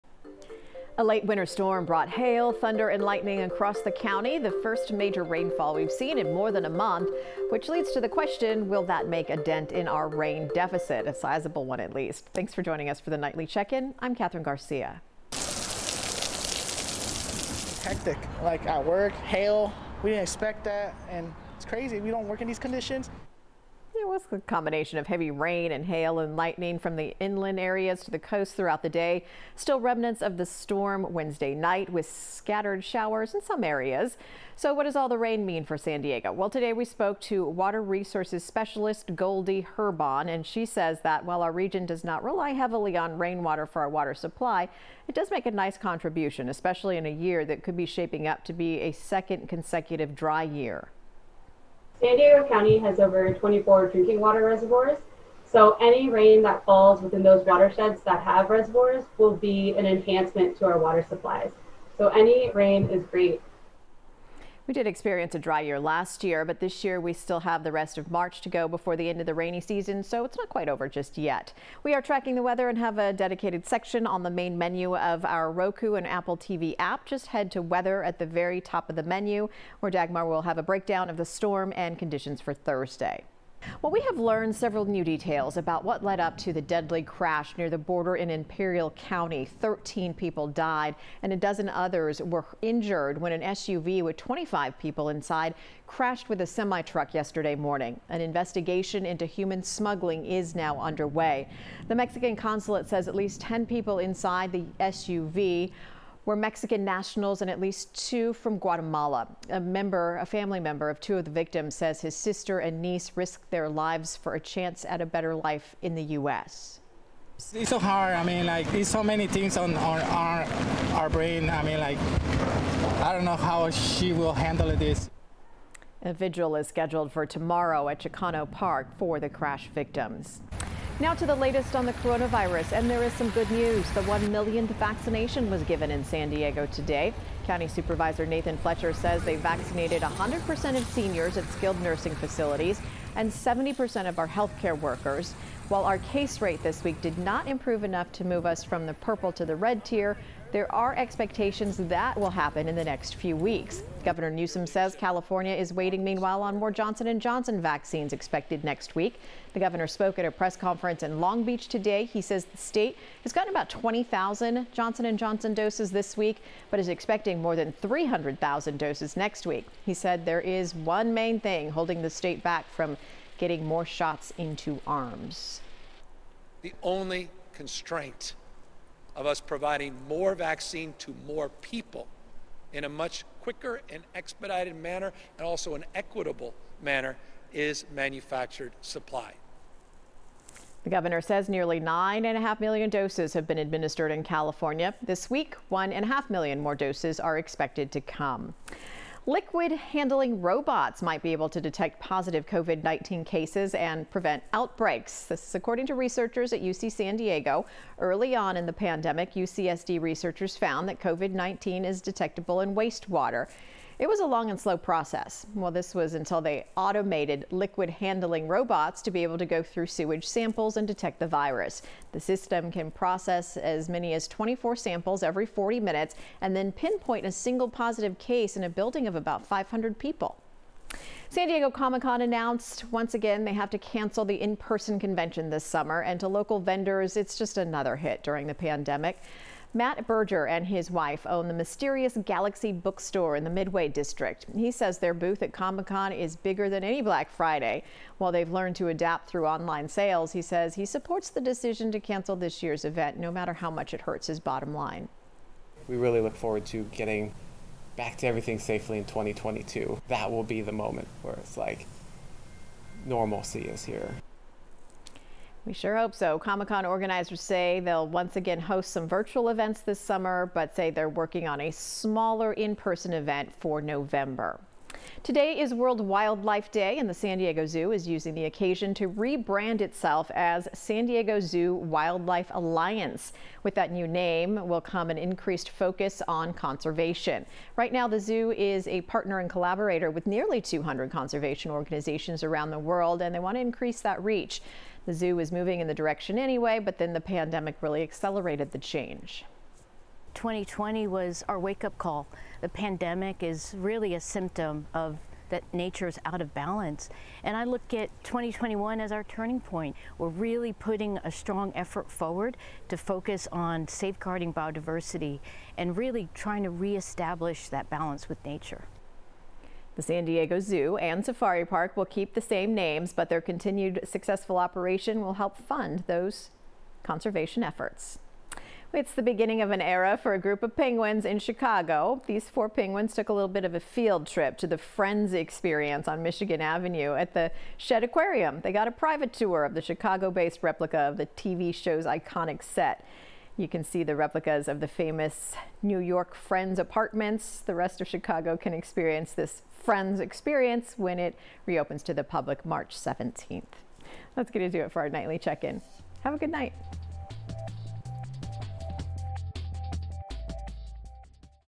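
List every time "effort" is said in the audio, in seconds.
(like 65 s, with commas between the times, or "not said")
311 s, 327 s.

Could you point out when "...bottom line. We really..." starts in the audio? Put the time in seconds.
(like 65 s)
254 s.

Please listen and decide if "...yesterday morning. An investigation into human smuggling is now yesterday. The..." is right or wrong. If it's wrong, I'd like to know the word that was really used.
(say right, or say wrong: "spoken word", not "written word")
wrong: "underway", not "yesterday".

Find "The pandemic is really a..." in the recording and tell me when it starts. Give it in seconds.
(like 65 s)
302 s.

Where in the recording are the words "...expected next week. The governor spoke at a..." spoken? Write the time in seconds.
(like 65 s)
158 s.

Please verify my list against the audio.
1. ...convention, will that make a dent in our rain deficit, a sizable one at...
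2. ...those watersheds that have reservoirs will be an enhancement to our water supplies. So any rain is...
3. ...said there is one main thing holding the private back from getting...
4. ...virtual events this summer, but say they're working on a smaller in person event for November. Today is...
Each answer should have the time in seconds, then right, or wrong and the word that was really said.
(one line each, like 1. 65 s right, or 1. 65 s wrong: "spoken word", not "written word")
1. 8 s wrong: "question", not "convention"
2. 57 s right
3. 169 s wrong: "state", not "private"
4. 269 s right.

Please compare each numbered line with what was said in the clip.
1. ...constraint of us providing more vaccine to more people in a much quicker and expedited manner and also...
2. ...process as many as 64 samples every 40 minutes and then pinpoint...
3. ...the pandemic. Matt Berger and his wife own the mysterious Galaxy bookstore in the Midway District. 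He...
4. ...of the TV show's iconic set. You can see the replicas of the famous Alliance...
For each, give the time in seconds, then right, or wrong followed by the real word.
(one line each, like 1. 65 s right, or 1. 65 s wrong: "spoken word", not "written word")
1. 177 s right
2. 222 s wrong: "24", not "64"
3. 238 s right
4. 340 s wrong: "New", not "Alliance".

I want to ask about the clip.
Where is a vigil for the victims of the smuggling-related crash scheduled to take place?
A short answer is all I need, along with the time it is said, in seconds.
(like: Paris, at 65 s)
Chicano Park, at 127 s.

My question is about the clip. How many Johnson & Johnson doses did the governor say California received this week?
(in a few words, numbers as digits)
about 20,000.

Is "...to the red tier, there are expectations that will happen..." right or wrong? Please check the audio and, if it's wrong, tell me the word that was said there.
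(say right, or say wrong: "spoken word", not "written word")
right.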